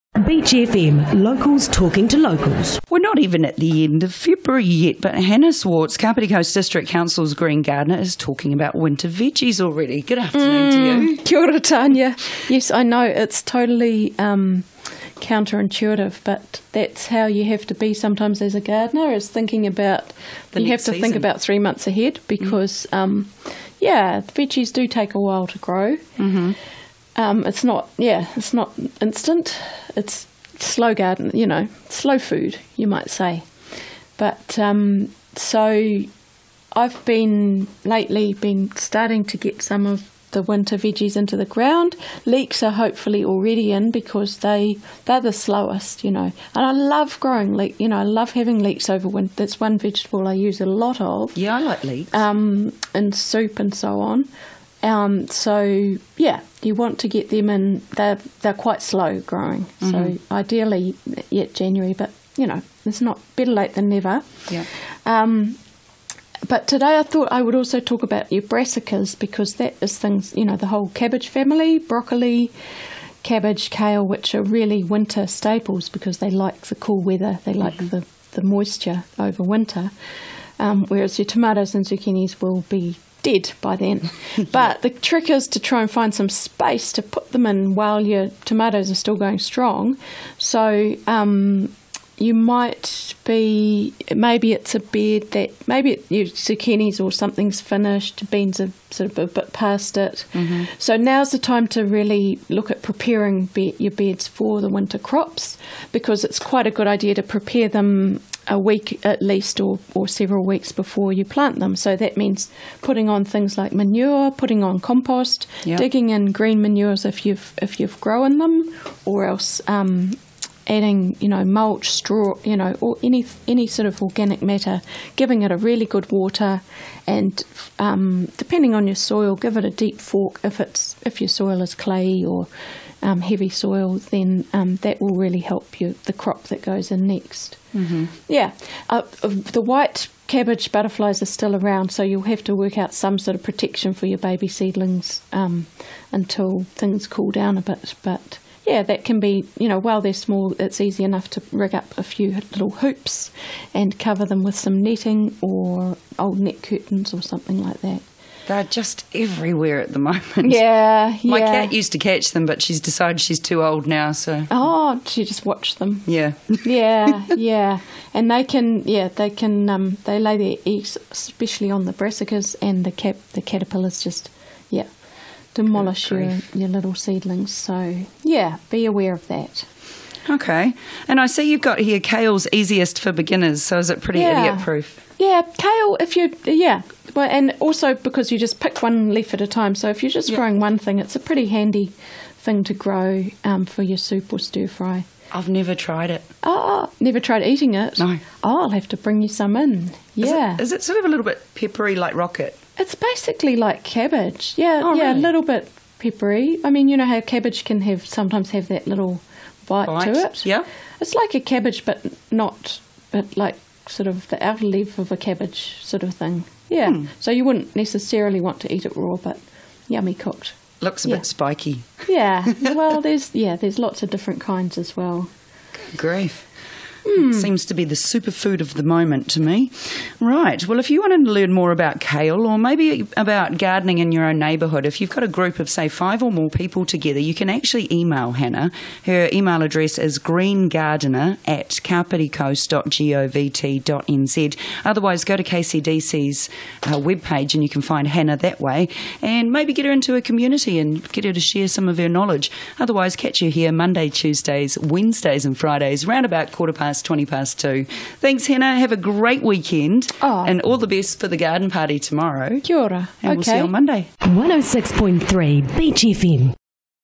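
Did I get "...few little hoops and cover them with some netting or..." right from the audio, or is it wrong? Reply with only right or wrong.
right.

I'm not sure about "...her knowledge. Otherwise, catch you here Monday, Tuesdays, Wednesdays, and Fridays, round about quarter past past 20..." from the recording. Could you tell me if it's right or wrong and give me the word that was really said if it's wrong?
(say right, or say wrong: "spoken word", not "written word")
right.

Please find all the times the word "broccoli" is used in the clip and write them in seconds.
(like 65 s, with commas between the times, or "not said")
71 s.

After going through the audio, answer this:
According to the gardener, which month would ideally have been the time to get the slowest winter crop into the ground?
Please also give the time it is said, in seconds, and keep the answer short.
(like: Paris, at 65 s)
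January, at 61 s.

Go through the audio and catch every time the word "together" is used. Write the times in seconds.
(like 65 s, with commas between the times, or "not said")
236 s.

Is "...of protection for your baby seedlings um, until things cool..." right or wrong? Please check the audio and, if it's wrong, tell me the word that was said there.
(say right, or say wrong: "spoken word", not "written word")
right.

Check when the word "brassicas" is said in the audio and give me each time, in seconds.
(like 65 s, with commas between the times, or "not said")
68 s, 171 s.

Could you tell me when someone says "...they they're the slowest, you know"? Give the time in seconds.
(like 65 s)
44 s.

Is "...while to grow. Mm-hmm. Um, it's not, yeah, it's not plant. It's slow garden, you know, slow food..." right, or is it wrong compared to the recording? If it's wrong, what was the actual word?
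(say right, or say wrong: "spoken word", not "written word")
wrong: "instant", not "plant".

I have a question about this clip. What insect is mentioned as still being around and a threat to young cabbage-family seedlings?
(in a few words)
White cabbage butterflies.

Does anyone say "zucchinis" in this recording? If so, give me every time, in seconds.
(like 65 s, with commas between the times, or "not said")
81 s, 96 s.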